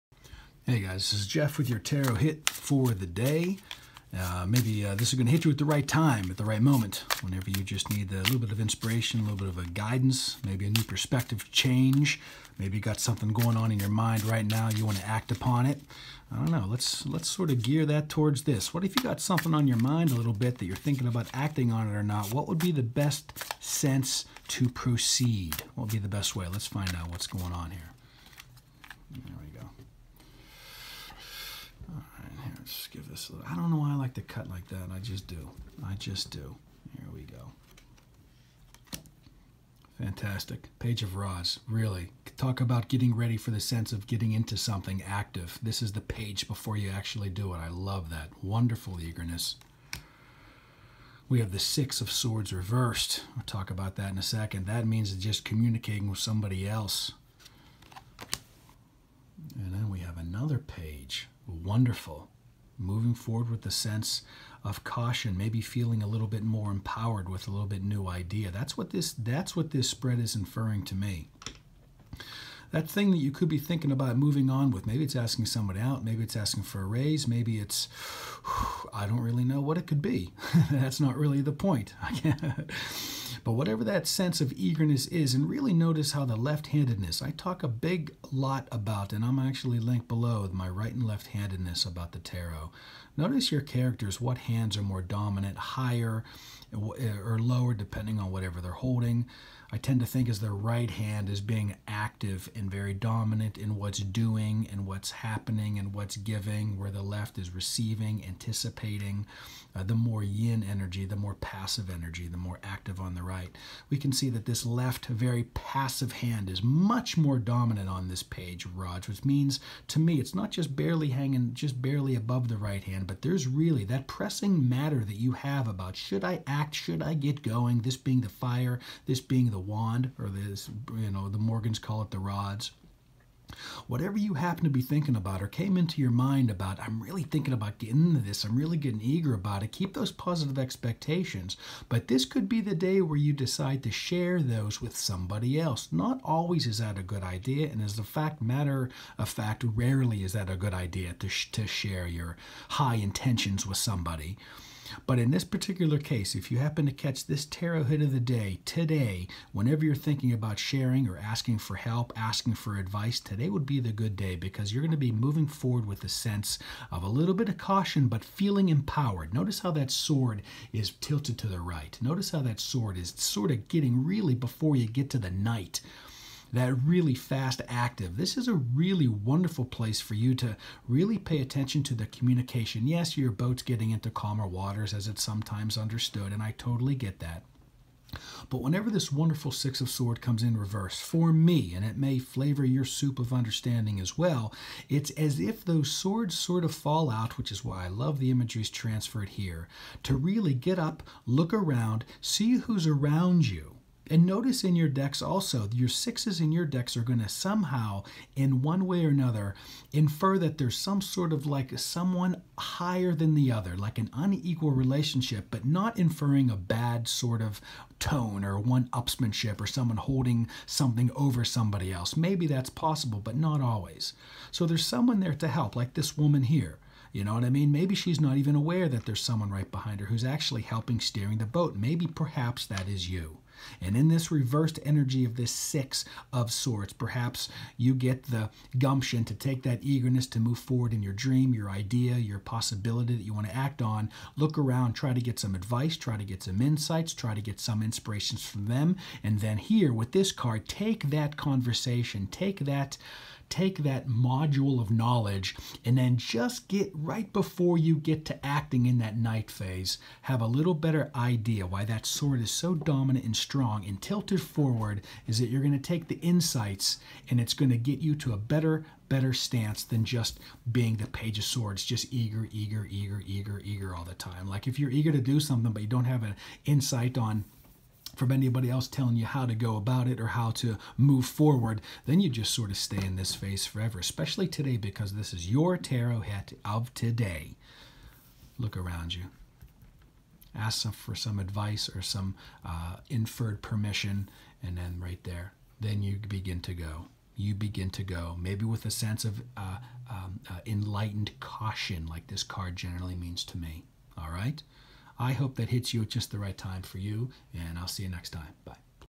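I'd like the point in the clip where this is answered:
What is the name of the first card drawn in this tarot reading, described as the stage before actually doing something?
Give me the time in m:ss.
0:40.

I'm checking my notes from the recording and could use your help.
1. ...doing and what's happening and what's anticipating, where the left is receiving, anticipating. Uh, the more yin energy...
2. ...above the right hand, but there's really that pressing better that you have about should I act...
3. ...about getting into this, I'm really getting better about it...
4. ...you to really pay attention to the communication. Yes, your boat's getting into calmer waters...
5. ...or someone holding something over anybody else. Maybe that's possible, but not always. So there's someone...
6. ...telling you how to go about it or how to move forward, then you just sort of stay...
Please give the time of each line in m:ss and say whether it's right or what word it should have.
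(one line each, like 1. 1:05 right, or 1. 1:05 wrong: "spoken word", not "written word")
1. 1:43 wrong: "giving", not "anticipating"
2. 2:02 wrong: "matter", not "better"
3. 2:17 wrong: "eager", not "better"
4. 3:00 right
5. 3:39 wrong: "somebody", not "anybody"
6. 4:38 right.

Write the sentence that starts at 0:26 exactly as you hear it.
Let's find out what's going on here.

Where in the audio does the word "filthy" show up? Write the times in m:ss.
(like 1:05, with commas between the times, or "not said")
not said.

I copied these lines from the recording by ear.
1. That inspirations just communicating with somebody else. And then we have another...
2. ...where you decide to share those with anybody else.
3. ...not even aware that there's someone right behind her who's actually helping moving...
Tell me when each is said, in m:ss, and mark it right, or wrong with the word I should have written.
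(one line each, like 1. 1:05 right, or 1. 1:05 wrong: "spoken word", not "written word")
1. 0:54 wrong: "means", not "inspirations"
2. 2:23 wrong: "somebody", not "anybody"
3. 3:48 wrong: "steering", not "moving".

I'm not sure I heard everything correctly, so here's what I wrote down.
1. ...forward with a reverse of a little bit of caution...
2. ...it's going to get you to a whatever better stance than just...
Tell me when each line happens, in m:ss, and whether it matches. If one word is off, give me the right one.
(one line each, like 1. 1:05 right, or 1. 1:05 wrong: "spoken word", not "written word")
1. 2:45 wrong: "sense", not "reverse"
2. 4:27 wrong: "better", not "whatever".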